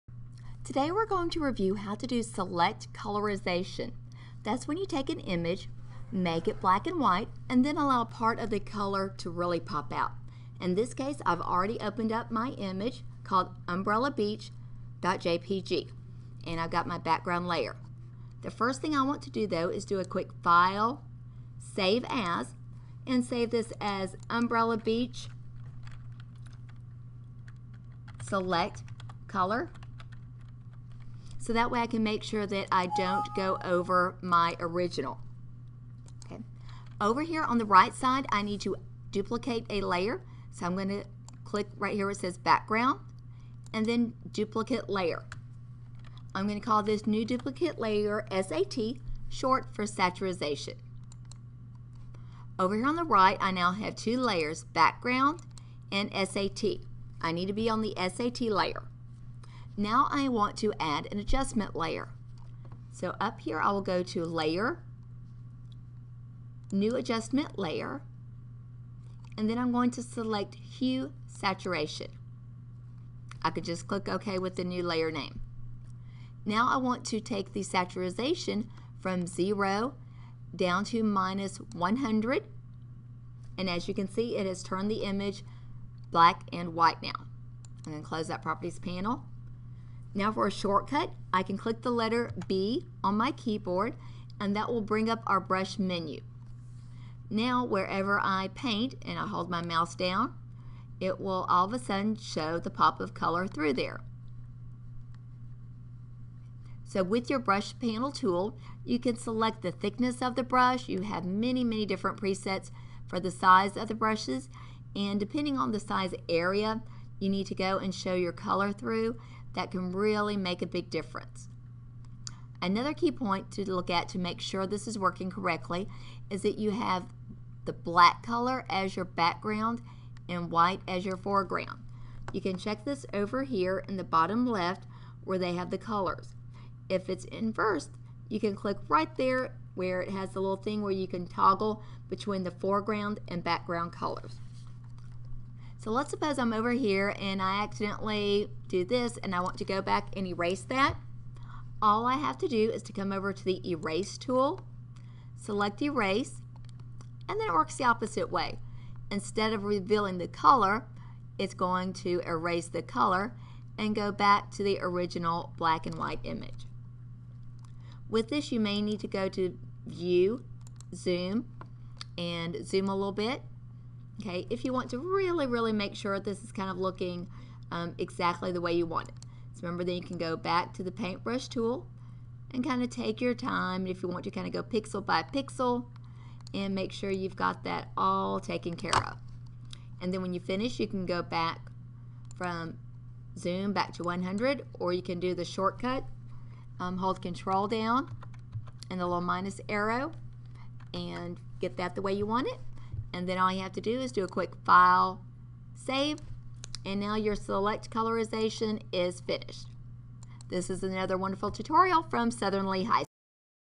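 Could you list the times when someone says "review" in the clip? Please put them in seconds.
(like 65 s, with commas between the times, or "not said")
1 s.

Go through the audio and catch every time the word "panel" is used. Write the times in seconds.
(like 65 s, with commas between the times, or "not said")
88 s, 107 s.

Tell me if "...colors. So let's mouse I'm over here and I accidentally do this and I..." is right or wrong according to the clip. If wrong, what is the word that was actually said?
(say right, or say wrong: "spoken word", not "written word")
wrong: "suppose", not "mouse".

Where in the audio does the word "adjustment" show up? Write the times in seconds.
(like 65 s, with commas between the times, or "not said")
61 s, 66 s.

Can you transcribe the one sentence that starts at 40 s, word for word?
So I'm going to click right here where it says background and then duplicate layer.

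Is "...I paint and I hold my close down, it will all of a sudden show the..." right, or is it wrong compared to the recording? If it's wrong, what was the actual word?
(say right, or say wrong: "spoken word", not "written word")
wrong: "mouse", not "close".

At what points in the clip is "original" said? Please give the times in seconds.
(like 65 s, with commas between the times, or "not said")
34 s, 164 s.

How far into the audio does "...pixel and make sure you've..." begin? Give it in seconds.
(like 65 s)
185 s.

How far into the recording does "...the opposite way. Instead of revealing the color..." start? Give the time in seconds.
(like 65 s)
157 s.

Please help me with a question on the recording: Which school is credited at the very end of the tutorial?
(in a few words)
Southern Lee High.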